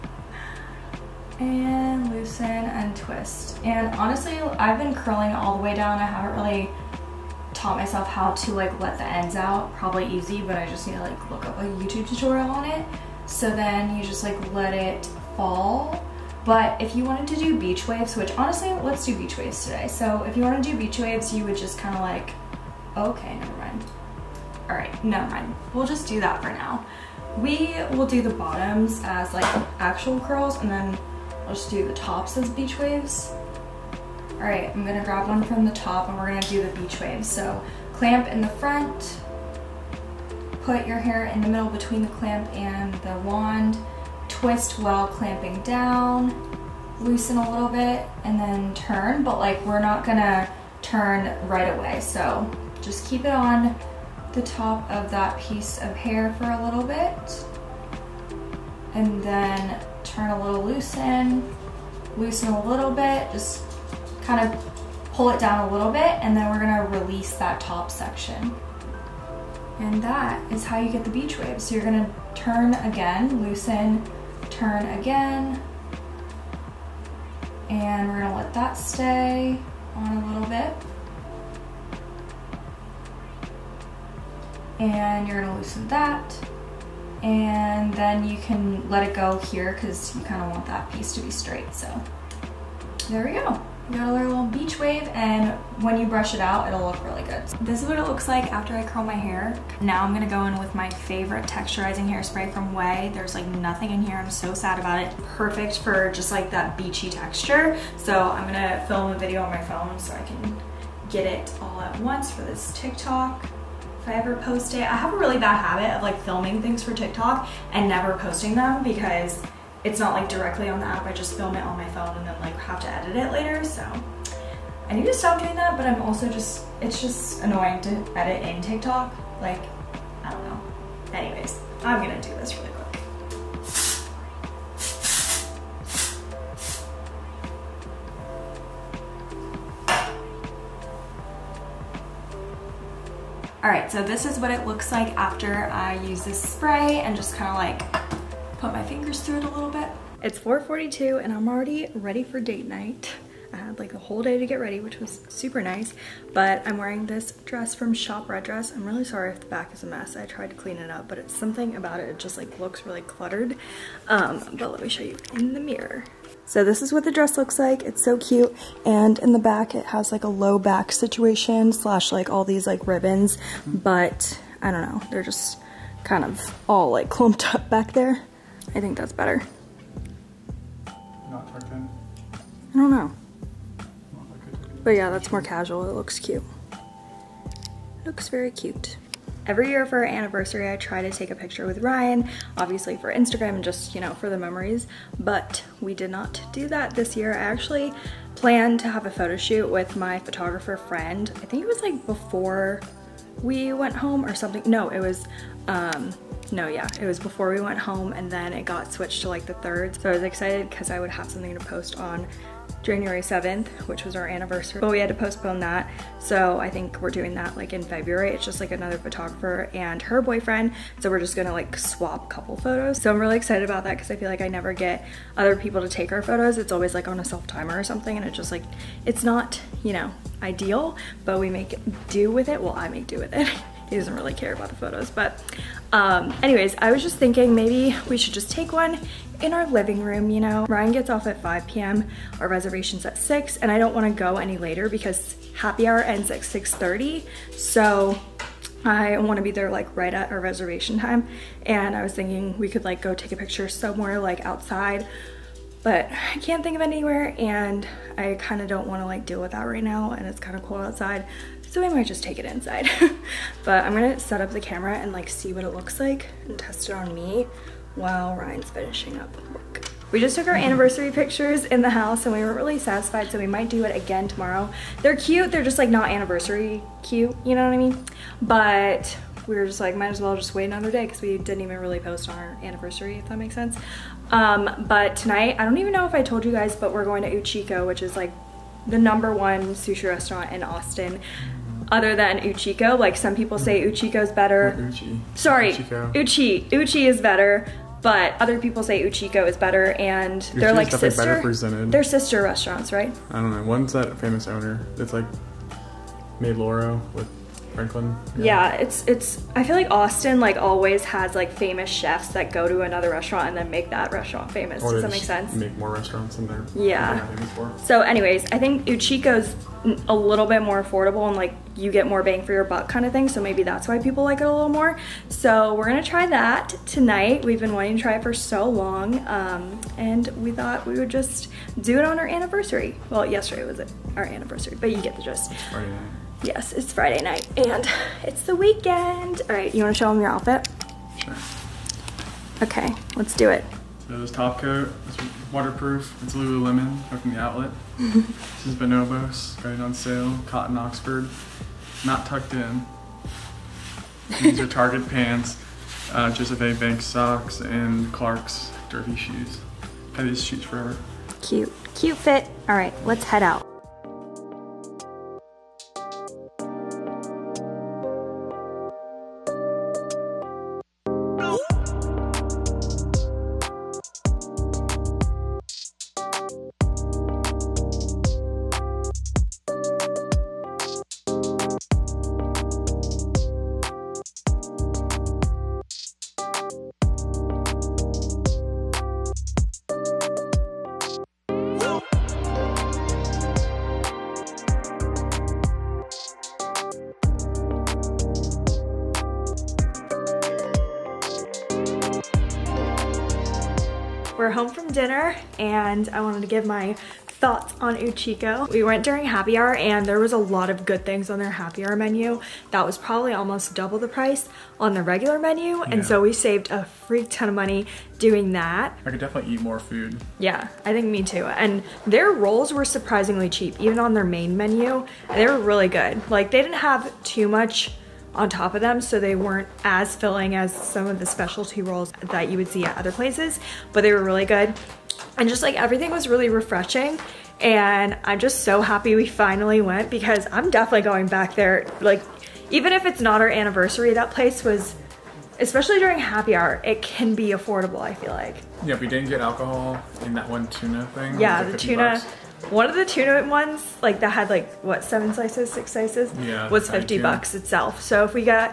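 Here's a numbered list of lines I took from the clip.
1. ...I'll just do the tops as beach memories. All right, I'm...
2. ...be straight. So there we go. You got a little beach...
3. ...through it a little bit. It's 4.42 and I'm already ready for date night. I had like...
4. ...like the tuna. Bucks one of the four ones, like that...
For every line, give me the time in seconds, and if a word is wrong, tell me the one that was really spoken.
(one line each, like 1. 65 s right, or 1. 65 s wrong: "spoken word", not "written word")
1. 31 s wrong: "waves", not "memories"
2. 91 s right
3. 149 s right
4. 451 s wrong: "two", not "four".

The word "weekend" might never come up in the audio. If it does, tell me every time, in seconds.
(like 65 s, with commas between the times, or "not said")
338 s.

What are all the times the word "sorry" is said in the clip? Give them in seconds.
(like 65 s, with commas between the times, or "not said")
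159 s, 295 s.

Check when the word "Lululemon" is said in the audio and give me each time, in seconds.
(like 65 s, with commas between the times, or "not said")
346 s.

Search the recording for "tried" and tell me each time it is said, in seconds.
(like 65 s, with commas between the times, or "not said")
160 s.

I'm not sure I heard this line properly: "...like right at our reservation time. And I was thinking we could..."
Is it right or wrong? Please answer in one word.
right.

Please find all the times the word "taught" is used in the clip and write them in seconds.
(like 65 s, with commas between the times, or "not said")
7 s.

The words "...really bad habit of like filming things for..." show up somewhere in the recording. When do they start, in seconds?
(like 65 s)
115 s.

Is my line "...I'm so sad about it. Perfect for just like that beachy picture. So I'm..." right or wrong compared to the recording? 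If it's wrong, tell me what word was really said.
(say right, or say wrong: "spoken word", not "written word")
wrong: "texture", not "picture".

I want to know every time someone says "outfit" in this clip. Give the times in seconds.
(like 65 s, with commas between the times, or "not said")
340 s.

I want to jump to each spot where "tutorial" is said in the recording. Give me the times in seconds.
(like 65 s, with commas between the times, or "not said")
12 s.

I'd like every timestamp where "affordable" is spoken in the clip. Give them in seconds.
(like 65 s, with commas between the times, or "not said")
320 s, 447 s.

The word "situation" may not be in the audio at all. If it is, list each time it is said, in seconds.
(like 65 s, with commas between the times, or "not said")
170 s.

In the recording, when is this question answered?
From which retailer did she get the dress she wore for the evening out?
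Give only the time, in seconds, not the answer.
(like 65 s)
157 s.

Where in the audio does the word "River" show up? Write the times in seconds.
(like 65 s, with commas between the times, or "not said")
not said.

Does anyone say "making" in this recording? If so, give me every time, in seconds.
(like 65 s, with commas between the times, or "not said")
not said.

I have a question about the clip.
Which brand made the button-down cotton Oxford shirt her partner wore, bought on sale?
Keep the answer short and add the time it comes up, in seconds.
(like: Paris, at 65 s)
Bonobos, at 348 s.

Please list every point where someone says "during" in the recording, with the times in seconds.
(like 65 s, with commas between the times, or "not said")
409 s, 445 s.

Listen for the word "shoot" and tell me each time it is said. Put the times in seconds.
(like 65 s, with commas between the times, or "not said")
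199 s.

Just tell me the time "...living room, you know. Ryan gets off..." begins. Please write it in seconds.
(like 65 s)
239 s.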